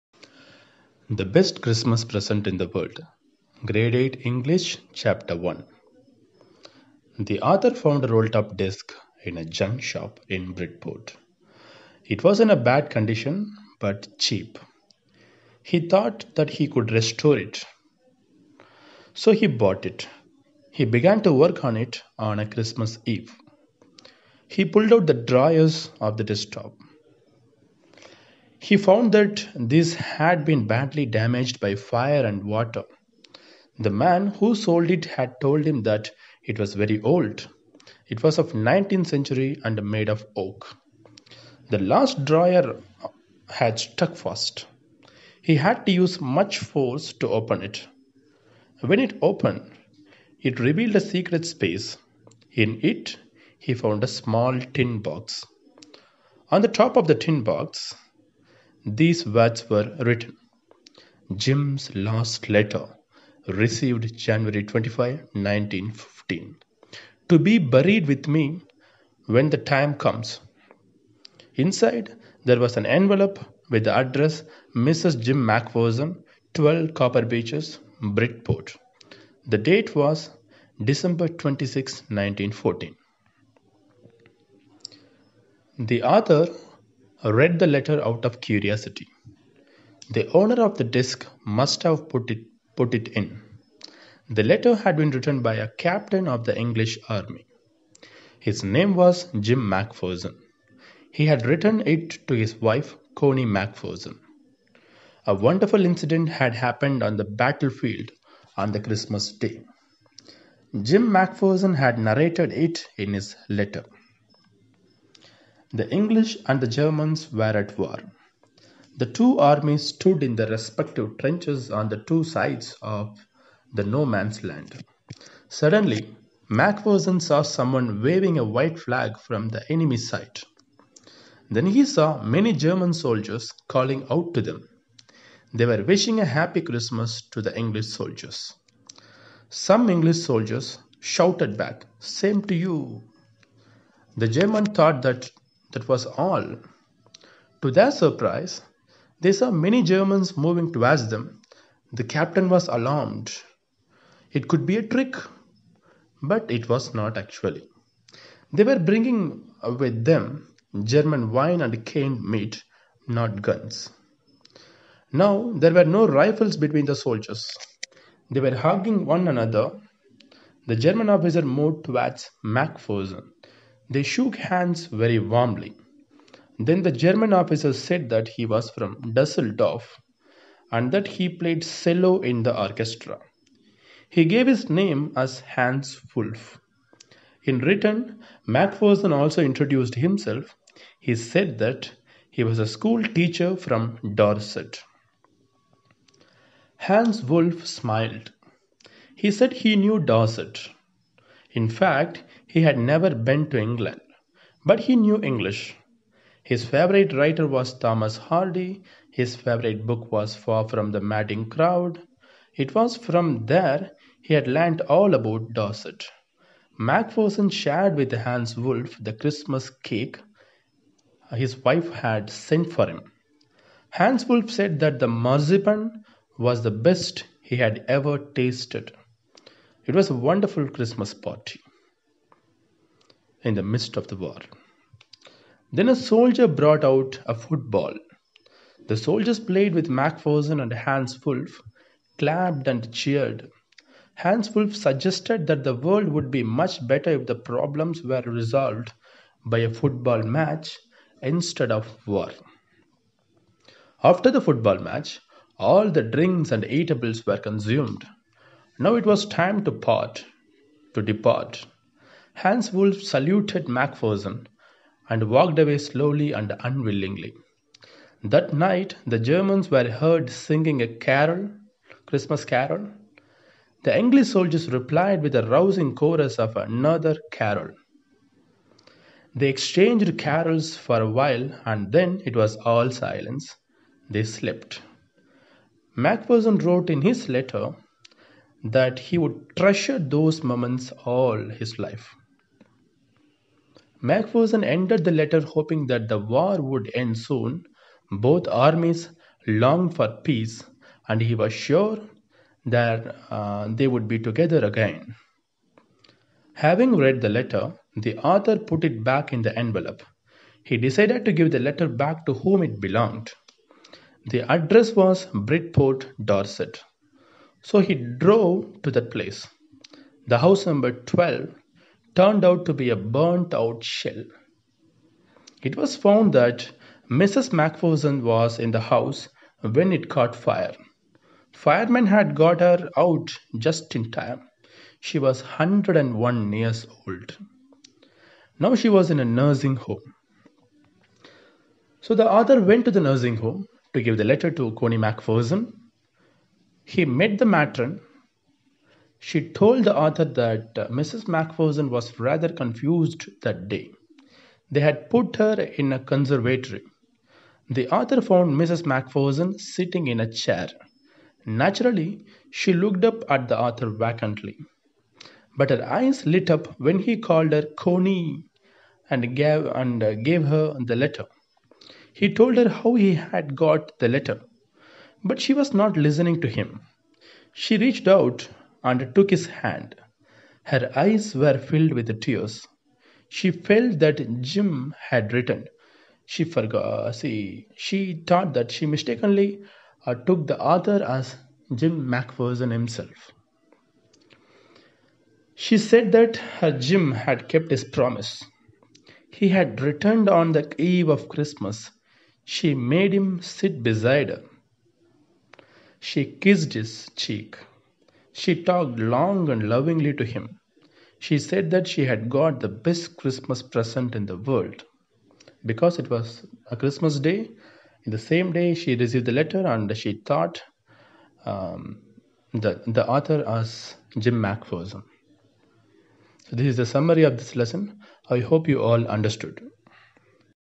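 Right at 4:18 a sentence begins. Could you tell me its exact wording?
Now it was time to part, to depart.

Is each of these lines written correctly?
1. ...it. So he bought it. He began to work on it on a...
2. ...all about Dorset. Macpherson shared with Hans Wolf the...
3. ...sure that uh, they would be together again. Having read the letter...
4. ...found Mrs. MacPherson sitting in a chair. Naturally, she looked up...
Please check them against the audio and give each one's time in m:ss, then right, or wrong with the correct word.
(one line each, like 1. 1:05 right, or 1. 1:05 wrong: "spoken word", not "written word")
1. 0:17 right
2. 3:34 right
3. 5:01 right
4. 5:58 right.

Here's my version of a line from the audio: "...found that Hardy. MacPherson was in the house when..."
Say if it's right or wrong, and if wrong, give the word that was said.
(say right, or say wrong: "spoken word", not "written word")
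wrong: "Mrs", not "Hardy".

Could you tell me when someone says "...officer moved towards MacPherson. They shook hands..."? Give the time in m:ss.
2:51.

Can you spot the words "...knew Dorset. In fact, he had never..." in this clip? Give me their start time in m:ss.
3:19.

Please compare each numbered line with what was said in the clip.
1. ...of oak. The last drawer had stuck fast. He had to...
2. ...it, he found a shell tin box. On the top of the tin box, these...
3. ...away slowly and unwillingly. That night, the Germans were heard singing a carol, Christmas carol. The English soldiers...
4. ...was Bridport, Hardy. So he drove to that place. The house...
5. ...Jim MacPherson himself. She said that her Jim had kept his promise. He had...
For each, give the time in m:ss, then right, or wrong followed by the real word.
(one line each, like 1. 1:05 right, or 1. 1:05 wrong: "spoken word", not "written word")
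1. 0:40 right
2. 0:52 wrong: "small", not "shell"
3. 4:25 right
4. 5:14 wrong: "Dorset", not "Hardy"
5. 6:31 right.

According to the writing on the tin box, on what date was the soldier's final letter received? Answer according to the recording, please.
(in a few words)
January 25, 1915.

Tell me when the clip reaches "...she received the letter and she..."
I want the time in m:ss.
6:58.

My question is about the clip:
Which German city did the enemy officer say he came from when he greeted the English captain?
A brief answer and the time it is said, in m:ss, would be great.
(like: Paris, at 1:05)
Dusseldorf, at 2:59.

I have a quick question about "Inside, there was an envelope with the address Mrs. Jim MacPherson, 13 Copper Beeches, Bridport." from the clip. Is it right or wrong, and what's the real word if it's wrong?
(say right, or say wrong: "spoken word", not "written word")
wrong: "12", not "13".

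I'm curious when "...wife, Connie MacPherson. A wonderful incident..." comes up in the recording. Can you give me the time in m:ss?
1:42.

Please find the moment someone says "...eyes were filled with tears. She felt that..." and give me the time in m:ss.
6:20.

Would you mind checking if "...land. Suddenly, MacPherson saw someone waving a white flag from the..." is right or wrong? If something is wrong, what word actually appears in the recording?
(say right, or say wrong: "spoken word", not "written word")
right.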